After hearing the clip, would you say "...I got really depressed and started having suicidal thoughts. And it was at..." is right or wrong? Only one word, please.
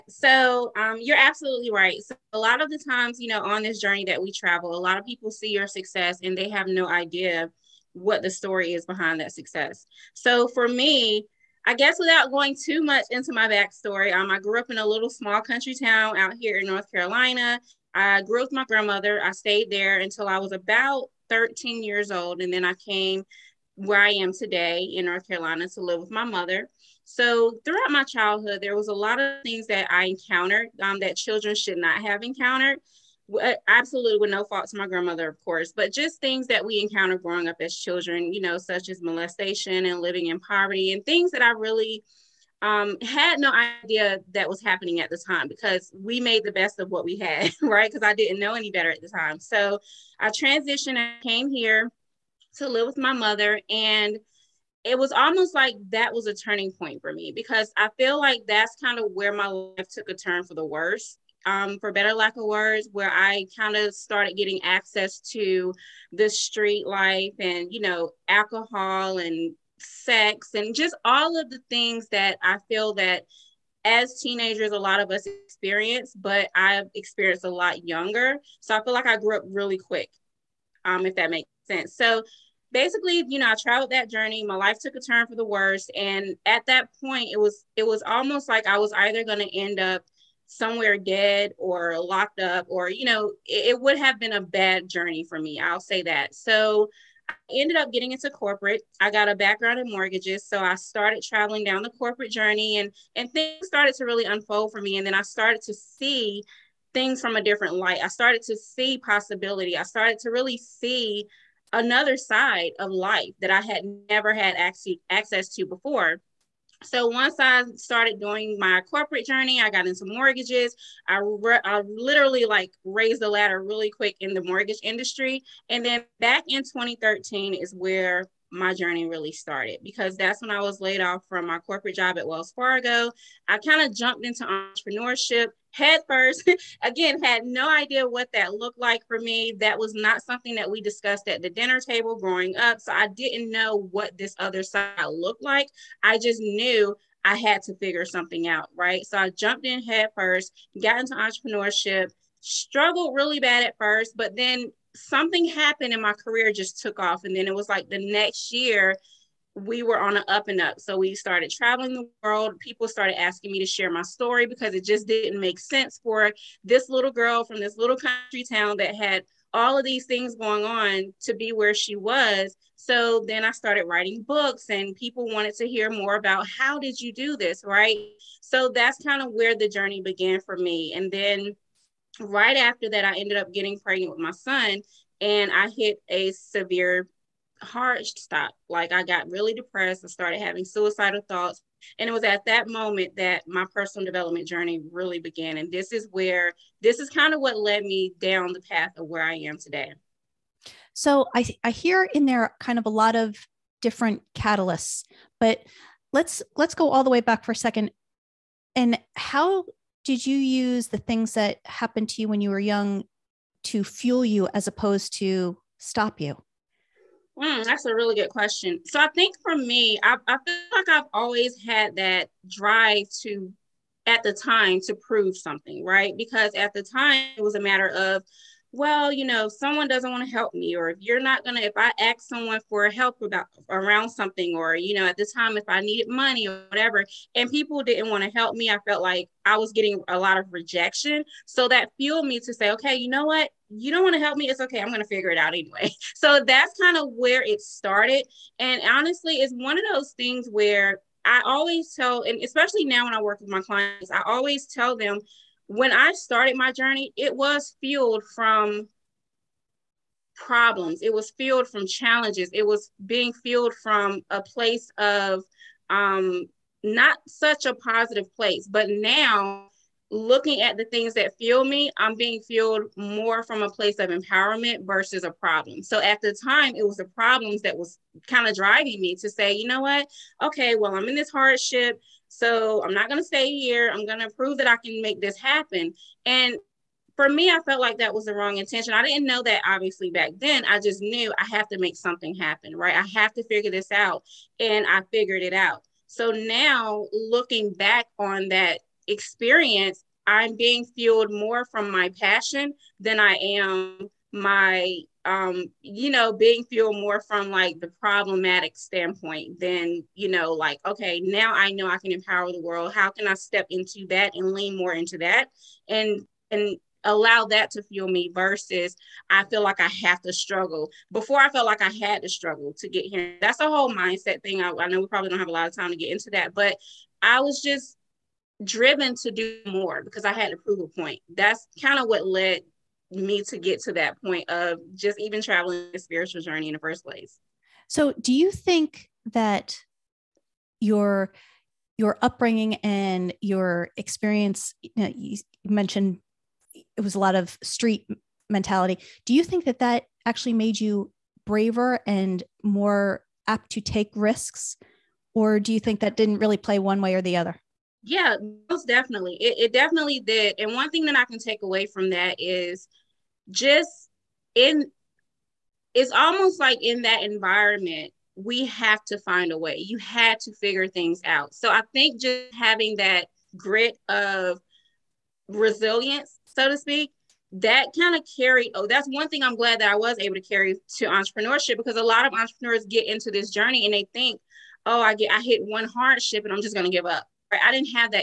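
right.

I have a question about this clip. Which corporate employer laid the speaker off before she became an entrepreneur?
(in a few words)
Wells Fargo.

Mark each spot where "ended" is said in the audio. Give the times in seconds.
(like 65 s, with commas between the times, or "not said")
97 s, 183 s.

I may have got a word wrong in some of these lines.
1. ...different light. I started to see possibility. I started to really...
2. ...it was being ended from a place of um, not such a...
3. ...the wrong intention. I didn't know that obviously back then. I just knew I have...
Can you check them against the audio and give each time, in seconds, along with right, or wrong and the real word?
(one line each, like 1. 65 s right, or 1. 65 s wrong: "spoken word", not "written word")
1. 107 s right
2. 262 s wrong: "fueled", not "ended"
3. 288 s right.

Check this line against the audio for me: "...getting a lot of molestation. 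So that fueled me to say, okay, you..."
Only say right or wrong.
wrong.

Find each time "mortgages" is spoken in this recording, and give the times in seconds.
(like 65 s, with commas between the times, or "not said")
99 s, 120 s, 124 s.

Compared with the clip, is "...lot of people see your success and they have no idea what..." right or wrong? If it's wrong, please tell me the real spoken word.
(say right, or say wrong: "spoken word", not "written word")
right.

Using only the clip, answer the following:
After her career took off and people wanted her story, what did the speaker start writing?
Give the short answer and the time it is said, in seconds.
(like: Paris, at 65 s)
Books, at 174 s.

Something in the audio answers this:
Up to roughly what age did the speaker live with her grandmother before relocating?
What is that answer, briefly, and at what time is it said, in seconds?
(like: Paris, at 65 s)
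13, at 21 s.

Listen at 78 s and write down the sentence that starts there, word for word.
So I feel like I grew up really quick, um, if that makes sense.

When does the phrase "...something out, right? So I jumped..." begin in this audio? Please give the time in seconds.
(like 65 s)
148 s.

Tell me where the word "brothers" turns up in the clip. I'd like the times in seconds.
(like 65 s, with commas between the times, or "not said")
not said.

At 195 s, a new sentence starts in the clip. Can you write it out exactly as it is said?
And this is where this is kind of what led me down the path of where I am today.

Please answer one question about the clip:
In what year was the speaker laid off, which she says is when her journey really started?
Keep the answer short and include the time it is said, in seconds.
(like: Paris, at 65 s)
2013, at 126 s.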